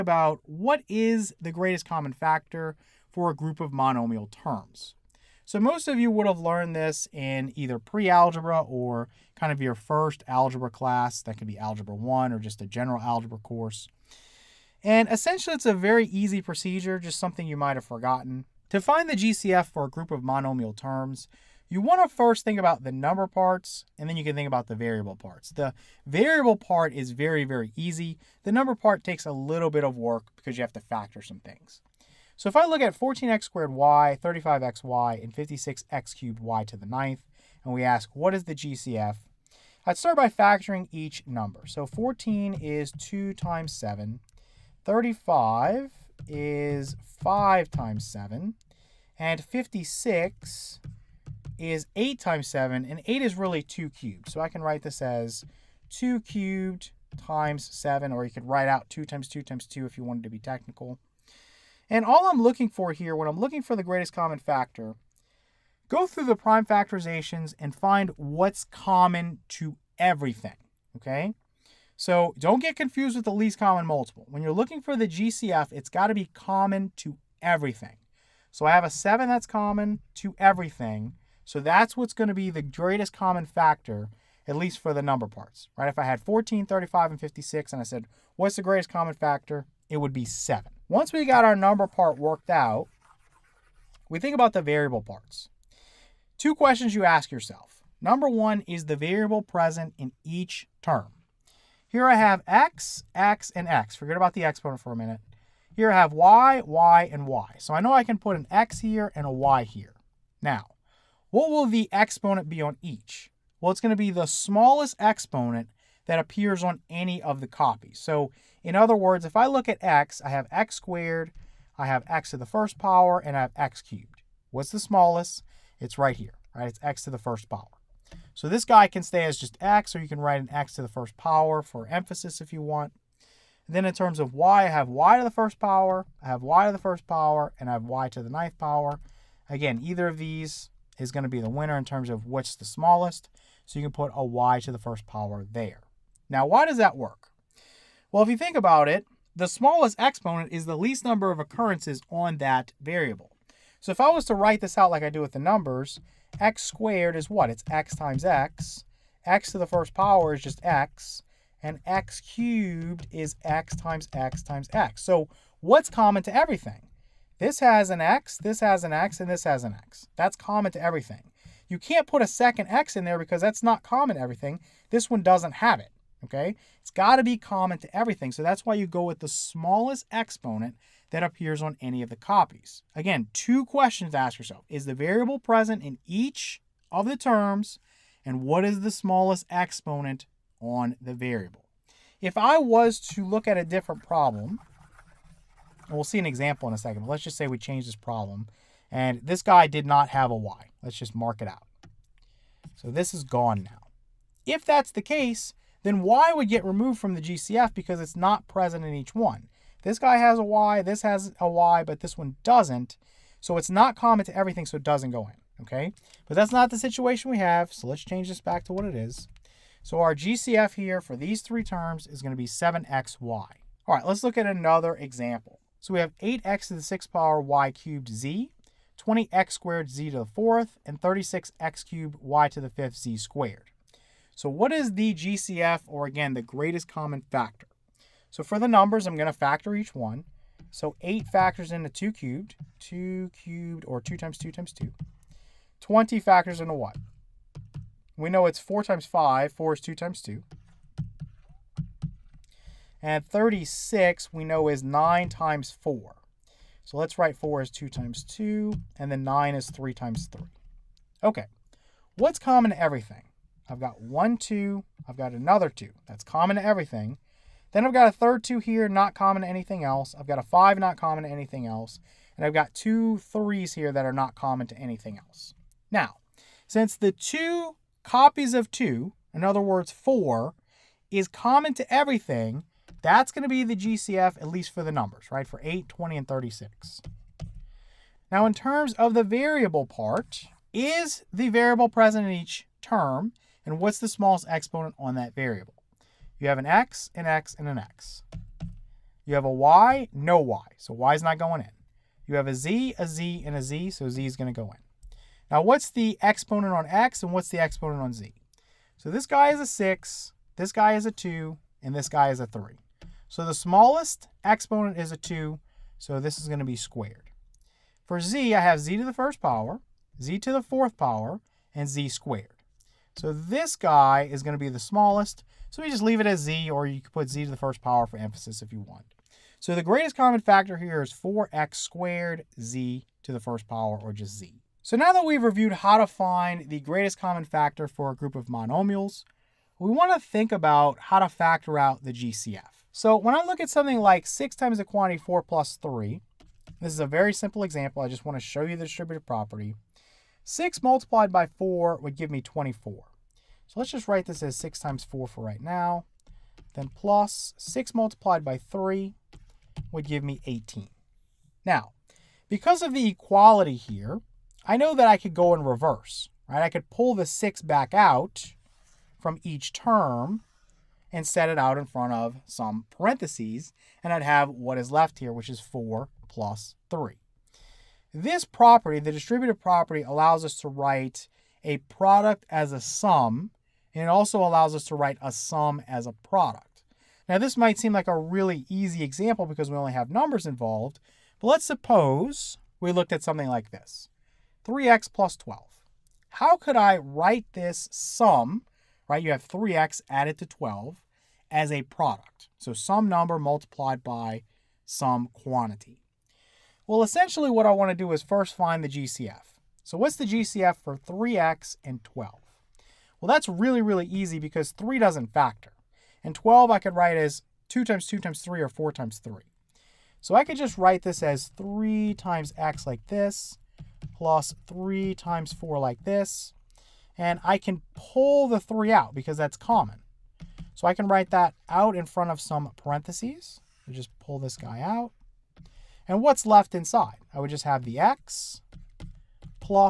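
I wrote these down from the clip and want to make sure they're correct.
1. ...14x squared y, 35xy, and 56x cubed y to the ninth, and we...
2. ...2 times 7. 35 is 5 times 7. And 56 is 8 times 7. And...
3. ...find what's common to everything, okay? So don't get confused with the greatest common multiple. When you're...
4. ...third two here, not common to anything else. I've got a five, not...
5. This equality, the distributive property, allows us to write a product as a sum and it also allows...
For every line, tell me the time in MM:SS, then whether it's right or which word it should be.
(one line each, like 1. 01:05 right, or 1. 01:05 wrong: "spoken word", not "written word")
1. 00:32 right
2. 00:42 right
3. 01:07 wrong: "least", not "greatest"
4. 04:28 right
5. 06:18 wrong: "property", not "equality".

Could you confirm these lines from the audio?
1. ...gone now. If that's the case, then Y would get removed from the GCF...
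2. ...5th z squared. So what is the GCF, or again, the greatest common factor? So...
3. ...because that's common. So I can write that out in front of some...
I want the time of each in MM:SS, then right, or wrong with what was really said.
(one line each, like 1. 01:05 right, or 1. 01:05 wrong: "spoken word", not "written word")
1. 03:23 right
2. 03:52 right
3. 07:09 right.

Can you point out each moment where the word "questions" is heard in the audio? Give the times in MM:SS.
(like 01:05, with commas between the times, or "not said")
01:36, 03:03.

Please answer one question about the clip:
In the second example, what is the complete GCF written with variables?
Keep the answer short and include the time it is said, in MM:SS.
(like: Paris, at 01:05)
4x squared z, at 05:31.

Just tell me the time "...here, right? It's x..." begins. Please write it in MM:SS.
02:06.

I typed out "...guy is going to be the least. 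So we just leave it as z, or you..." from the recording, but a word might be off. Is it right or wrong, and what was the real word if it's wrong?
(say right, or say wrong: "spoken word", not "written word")
wrong: "smallest", not "least".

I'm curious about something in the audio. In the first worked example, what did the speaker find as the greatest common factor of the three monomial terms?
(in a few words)
7xy.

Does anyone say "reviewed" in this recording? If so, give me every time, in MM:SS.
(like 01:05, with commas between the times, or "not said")
05:35.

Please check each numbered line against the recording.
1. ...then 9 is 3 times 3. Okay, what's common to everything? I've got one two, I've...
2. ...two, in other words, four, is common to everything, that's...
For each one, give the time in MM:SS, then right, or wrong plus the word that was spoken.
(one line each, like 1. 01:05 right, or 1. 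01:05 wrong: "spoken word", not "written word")
1. 04:19 right
2. 04:38 right.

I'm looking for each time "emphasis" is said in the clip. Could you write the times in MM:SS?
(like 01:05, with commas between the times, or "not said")
02:11, 05:28.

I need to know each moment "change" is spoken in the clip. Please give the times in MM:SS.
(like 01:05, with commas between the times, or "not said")
03:17, 03:38.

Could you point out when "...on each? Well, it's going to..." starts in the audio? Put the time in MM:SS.
01:52.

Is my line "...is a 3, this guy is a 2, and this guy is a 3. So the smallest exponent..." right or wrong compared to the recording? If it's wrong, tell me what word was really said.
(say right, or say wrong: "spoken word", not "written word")
wrong: "6", not "3".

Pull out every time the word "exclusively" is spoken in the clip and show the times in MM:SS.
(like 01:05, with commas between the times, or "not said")
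not said.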